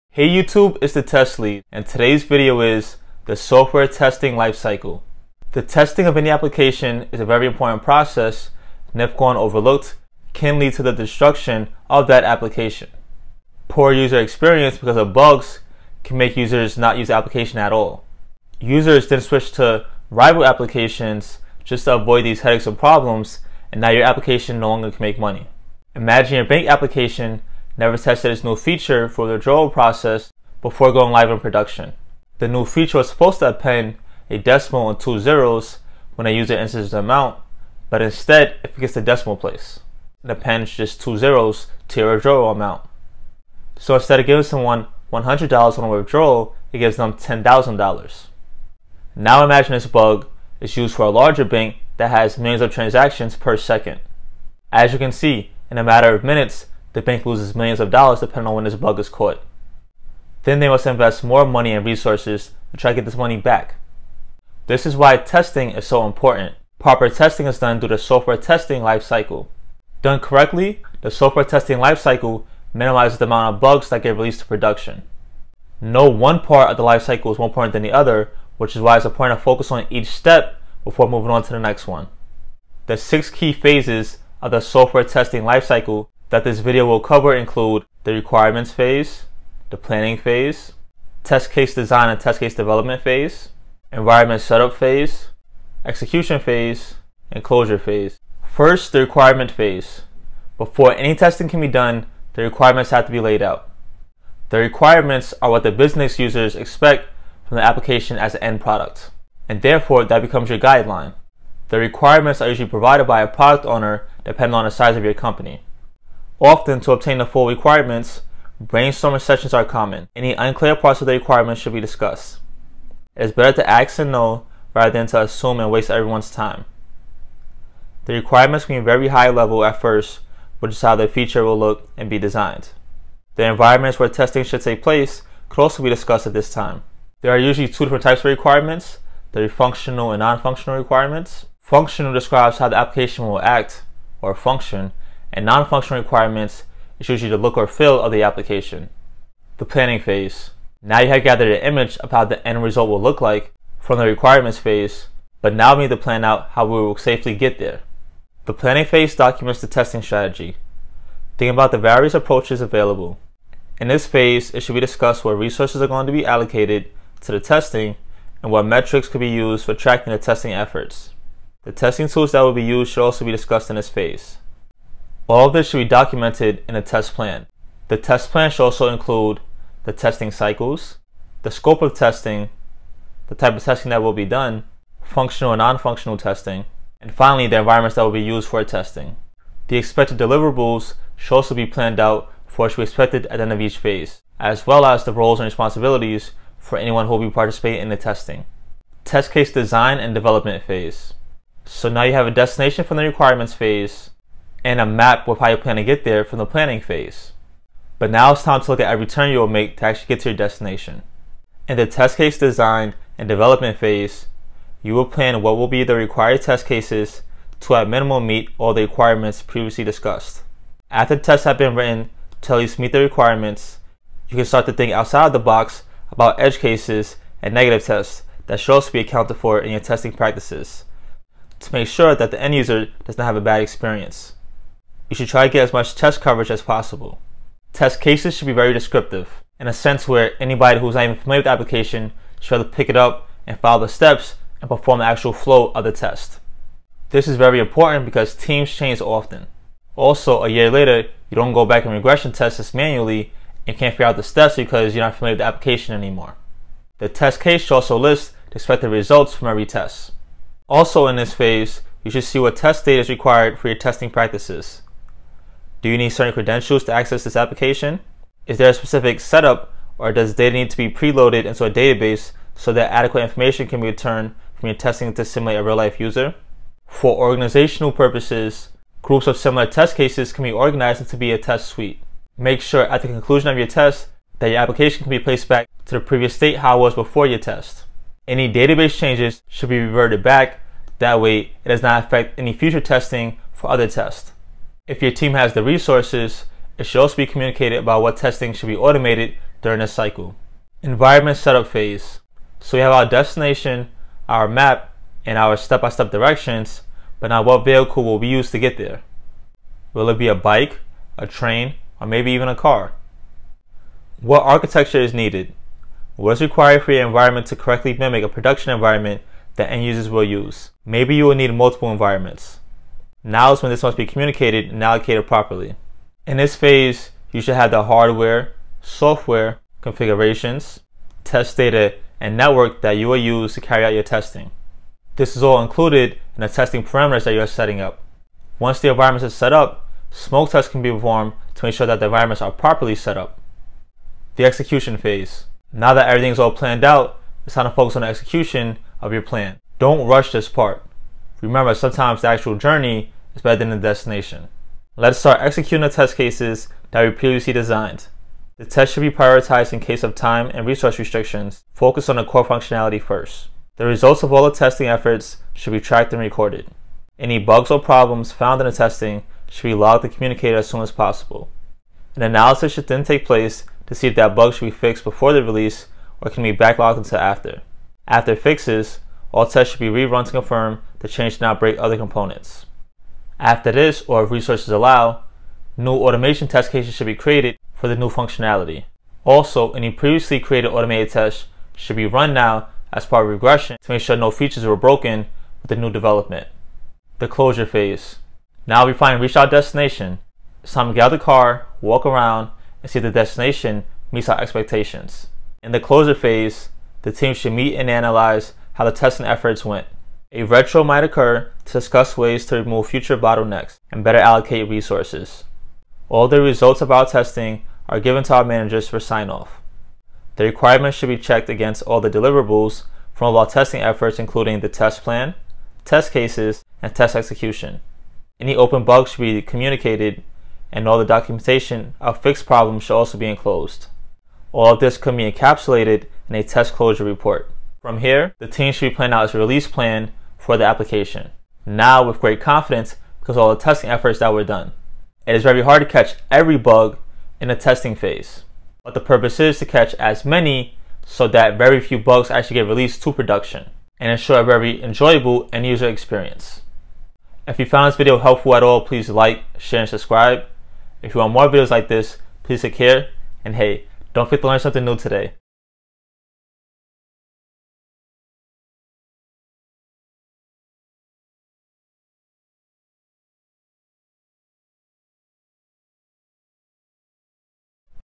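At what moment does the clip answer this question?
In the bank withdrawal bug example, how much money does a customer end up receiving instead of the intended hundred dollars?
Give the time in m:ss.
0:47.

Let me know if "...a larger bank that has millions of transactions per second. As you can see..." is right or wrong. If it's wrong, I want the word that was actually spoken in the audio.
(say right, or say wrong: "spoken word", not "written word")
right.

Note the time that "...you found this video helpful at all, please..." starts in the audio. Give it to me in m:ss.
7:37.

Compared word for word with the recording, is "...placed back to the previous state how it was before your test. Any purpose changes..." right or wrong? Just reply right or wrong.
wrong.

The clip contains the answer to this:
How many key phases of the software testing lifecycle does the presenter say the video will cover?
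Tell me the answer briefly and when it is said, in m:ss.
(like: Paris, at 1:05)
6, at 1:22.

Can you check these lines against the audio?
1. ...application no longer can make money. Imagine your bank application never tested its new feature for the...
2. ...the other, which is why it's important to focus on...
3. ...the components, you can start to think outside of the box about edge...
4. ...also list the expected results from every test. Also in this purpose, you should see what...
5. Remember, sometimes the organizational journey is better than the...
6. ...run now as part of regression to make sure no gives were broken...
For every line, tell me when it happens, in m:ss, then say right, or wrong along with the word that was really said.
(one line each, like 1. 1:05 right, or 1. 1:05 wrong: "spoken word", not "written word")
1. 0:24 right
2. 1:17 right
3. 3:42 wrong: "requirements", not "components"
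4. 4:17 wrong: "phase", not "purpose"
5. 5:51 wrong: "actual", not "organizational"
6. 6:32 wrong: "features", not "gives".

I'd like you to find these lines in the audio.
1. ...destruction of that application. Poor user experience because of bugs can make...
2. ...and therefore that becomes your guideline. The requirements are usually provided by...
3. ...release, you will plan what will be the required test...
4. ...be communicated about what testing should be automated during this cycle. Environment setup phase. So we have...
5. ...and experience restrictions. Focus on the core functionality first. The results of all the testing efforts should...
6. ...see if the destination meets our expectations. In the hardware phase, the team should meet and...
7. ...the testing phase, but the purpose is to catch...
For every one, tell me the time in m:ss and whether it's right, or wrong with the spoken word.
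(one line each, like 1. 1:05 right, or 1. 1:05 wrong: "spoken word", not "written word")
1. 0:10 right
2. 1:49 right
3. 3:33 wrong: "phase", not "release"
4. 4:57 right
5. 6:00 wrong: "resource", not "experience"
6. 6:42 wrong: "closure", not "hardware"
7. 7:27 right.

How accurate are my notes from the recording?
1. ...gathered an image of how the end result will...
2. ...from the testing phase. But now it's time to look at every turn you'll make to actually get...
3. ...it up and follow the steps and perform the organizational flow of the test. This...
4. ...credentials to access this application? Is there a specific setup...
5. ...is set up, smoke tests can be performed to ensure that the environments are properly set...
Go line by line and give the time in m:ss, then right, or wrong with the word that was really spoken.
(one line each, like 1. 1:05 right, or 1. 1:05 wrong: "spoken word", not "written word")
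1. 2:31 right
2. 3:26 wrong: "planning", not "testing"
3. 4:02 wrong: "actual", not "organizational"
4. 4:26 right
5. 5:39 right.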